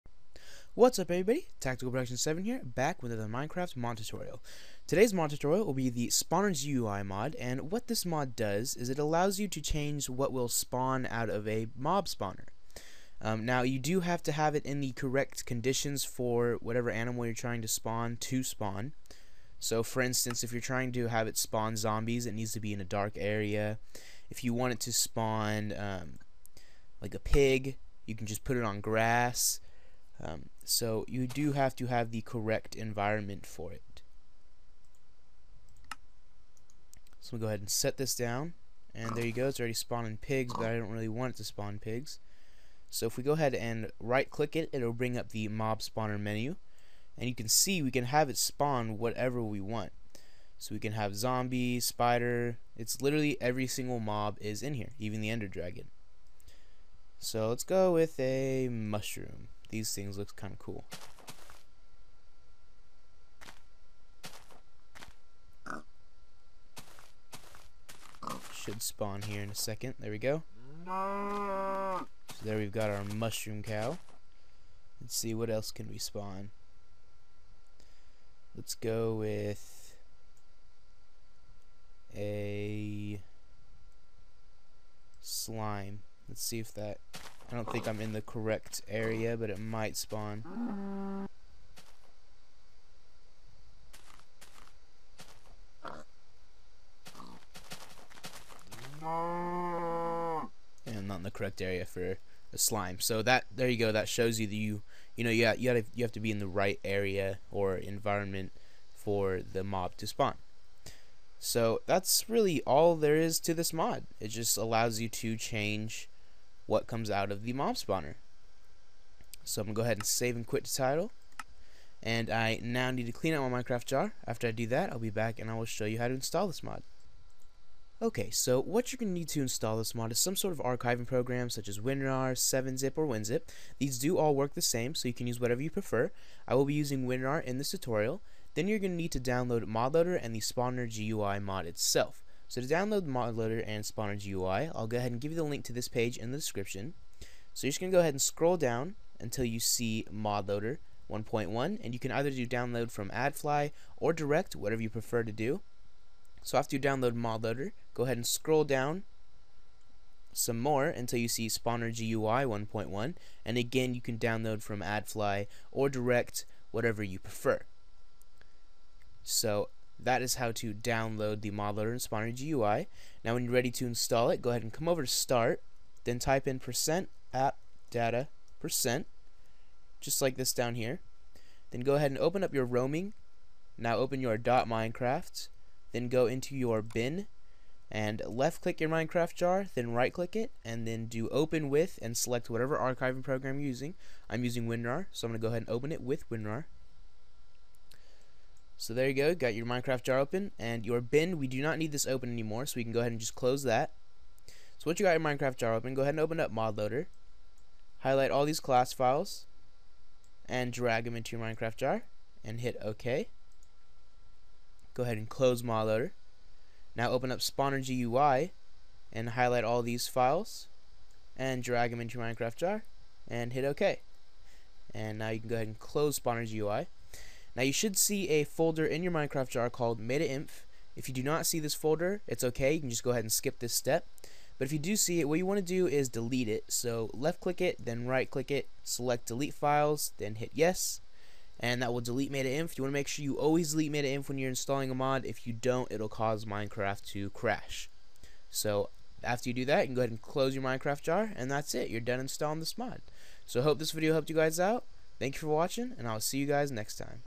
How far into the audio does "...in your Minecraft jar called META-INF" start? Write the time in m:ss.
3:48.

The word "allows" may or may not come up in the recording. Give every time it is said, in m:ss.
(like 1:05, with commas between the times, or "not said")
0:08, 1:54.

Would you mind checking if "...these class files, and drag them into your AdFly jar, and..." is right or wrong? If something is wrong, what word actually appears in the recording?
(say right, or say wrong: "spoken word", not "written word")
wrong: "Minecraft", not "AdFly".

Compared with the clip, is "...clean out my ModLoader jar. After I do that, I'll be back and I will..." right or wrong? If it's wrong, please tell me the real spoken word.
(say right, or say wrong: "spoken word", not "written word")
wrong: "Minecraft", not "ModLoader".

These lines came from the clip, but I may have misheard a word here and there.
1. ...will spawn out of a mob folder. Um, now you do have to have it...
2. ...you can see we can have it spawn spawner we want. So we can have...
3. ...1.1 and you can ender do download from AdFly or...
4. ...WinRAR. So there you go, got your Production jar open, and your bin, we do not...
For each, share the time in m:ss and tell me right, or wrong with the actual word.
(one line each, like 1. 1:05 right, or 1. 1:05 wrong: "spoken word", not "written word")
1. 0:10 wrong: "spawner", not "folder"
2. 0:47 wrong: "whatever", not "spawner"
3. 2:31 wrong: "either", not "ender"
4. 3:16 wrong: "Minecraft", not "Production".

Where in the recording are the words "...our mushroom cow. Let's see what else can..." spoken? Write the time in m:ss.
1:12.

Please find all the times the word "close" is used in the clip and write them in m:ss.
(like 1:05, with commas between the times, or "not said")
3:23, 3:35, 3:45, 4:10.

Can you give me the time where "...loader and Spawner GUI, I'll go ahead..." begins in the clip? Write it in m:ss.
2:23.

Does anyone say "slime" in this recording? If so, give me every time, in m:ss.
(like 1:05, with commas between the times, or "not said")
1:25, 1:42.